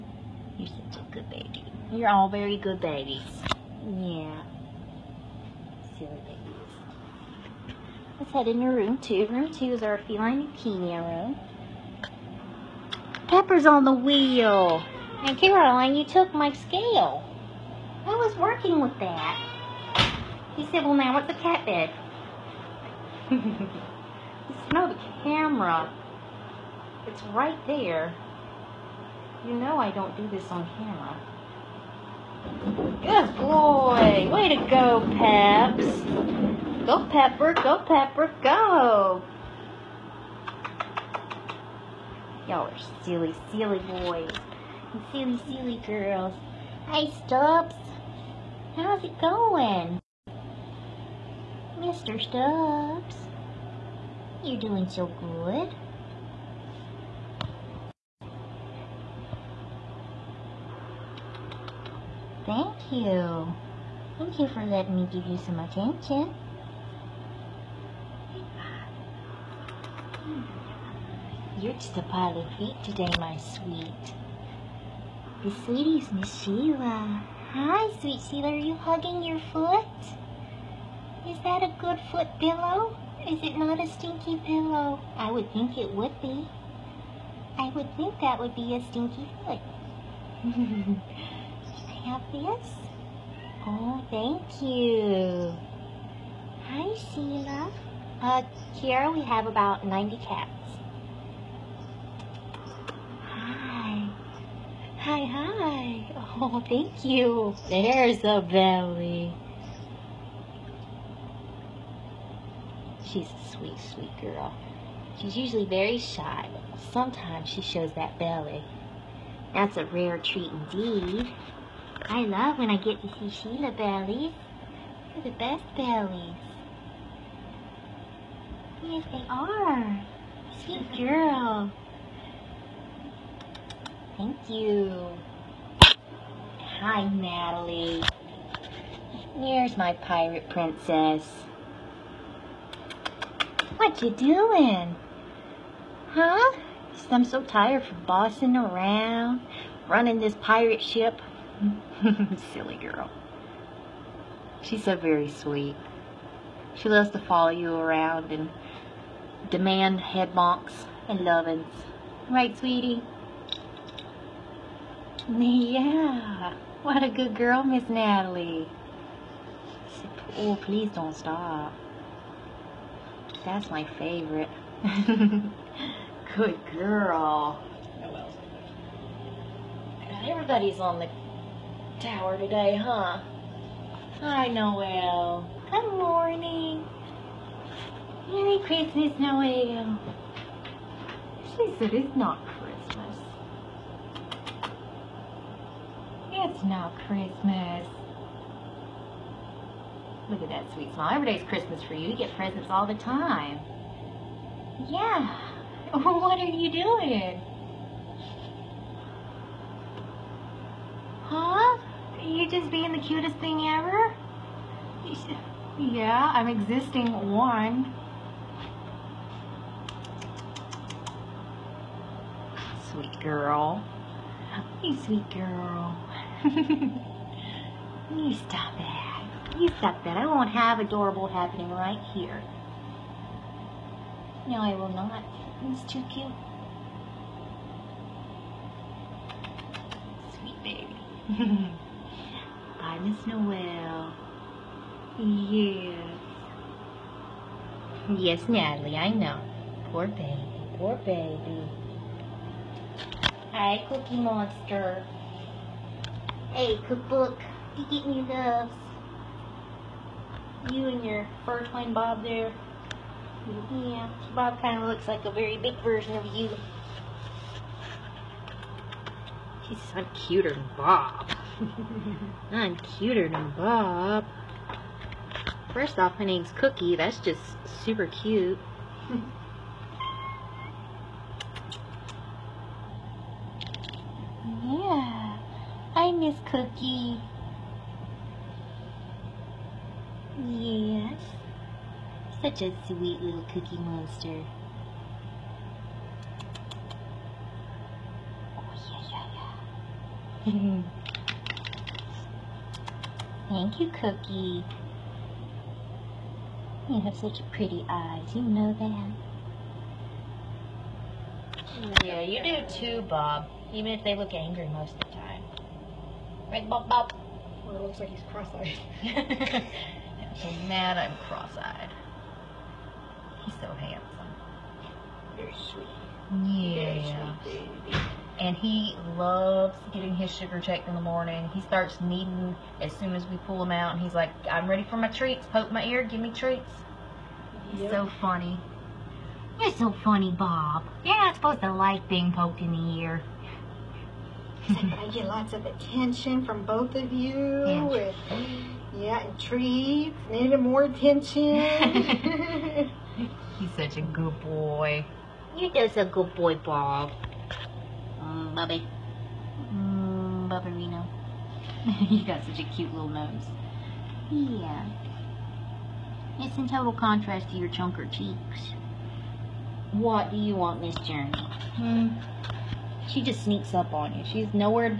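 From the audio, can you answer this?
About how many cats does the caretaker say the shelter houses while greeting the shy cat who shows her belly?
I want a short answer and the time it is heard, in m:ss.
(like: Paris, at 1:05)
90, at 1:39.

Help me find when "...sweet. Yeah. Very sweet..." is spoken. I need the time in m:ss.
5:25.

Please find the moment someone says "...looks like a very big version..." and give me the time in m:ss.
4:24.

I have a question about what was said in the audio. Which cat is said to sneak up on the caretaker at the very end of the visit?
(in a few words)
Journey.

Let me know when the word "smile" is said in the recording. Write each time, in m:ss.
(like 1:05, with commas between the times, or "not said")
3:20.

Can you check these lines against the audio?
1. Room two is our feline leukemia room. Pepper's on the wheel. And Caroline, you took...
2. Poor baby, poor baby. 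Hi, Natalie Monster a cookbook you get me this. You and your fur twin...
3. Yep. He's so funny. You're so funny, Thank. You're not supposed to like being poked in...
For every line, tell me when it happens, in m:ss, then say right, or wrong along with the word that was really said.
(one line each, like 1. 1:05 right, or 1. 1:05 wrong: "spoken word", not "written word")
1. 0:09 right
2. 4:09 wrong: "Cookie", not "Natalie"
3. 5:37 wrong: "Bob", not "Thank".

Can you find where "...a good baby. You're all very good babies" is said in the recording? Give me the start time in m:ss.
0:00.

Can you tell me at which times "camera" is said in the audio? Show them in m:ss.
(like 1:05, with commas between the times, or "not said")
0:25, 0:30.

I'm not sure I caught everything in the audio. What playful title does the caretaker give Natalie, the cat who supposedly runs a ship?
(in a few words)
pirate princess.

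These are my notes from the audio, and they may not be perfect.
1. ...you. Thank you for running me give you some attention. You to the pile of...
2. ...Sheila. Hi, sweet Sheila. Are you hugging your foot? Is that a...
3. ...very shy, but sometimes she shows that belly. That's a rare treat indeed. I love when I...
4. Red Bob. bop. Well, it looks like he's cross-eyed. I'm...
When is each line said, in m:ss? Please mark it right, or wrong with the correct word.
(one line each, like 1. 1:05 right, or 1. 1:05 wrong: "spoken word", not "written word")
1. 1:02 wrong: "letting", not "running"
2. 1:16 right
3. 1:55 right
4. 5:16 right.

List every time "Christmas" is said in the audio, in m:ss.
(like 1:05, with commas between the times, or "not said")
3:08, 3:17, 3:21.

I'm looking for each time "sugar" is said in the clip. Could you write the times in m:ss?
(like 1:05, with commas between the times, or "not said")
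5:30.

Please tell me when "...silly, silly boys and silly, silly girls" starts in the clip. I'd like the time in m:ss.
0:43.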